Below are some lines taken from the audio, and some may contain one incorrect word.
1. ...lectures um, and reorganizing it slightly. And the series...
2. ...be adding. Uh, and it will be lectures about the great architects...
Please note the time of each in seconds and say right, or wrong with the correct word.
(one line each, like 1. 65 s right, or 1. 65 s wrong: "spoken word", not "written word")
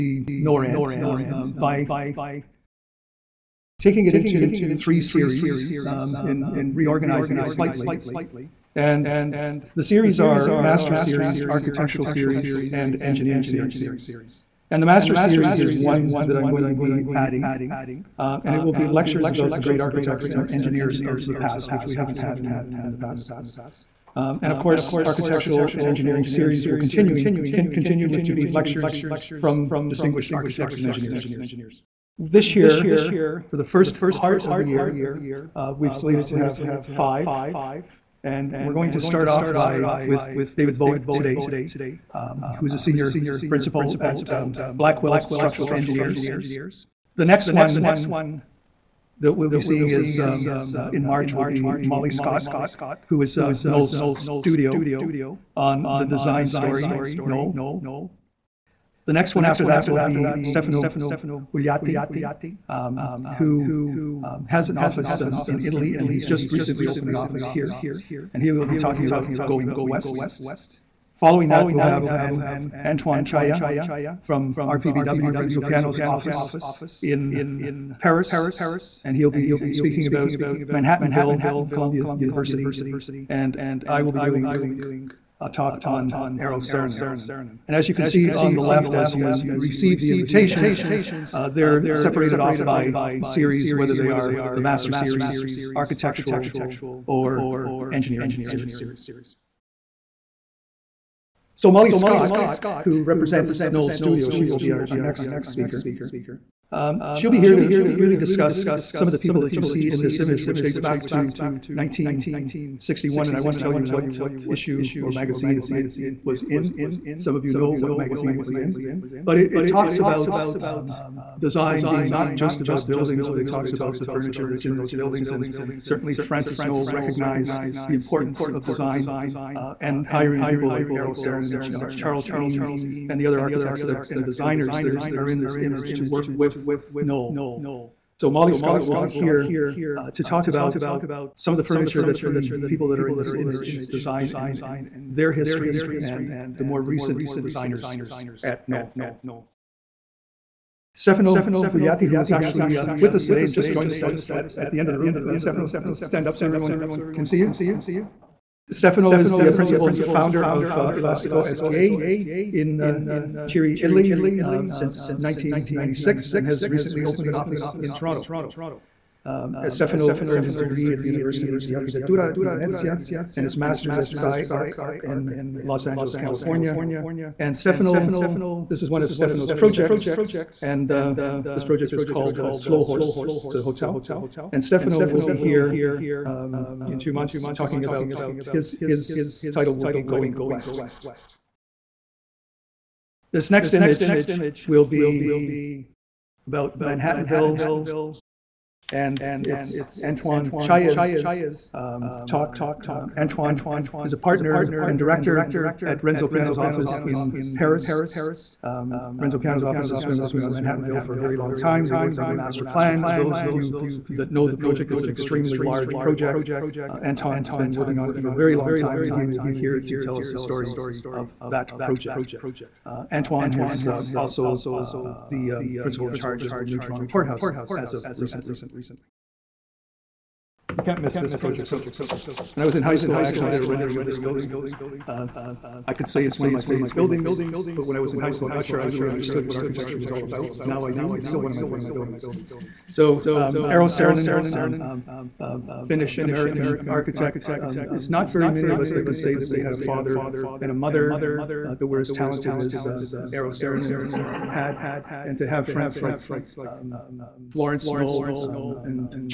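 1. 5 s wrong: "series", not "lectures"
2. 16 s right.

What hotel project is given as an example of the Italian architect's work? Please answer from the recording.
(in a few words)
Slow Horse.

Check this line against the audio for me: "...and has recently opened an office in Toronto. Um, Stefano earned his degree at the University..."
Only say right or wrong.
right.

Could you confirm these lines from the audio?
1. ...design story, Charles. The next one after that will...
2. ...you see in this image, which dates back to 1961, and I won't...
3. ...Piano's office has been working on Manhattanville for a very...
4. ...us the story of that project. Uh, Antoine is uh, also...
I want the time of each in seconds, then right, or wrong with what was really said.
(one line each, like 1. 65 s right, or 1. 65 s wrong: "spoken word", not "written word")
1. 56 s wrong: "Knoll", not "Charles"
2. 109 s right
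3. 209 s right
4. 220 s right.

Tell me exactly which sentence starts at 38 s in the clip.
And we're going to start off by with David Bowick today, um, who is a senior principal at um, Blackwell Structural Engineers.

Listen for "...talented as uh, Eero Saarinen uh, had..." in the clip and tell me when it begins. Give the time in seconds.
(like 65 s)
252 s.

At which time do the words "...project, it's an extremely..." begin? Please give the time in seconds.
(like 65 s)
214 s.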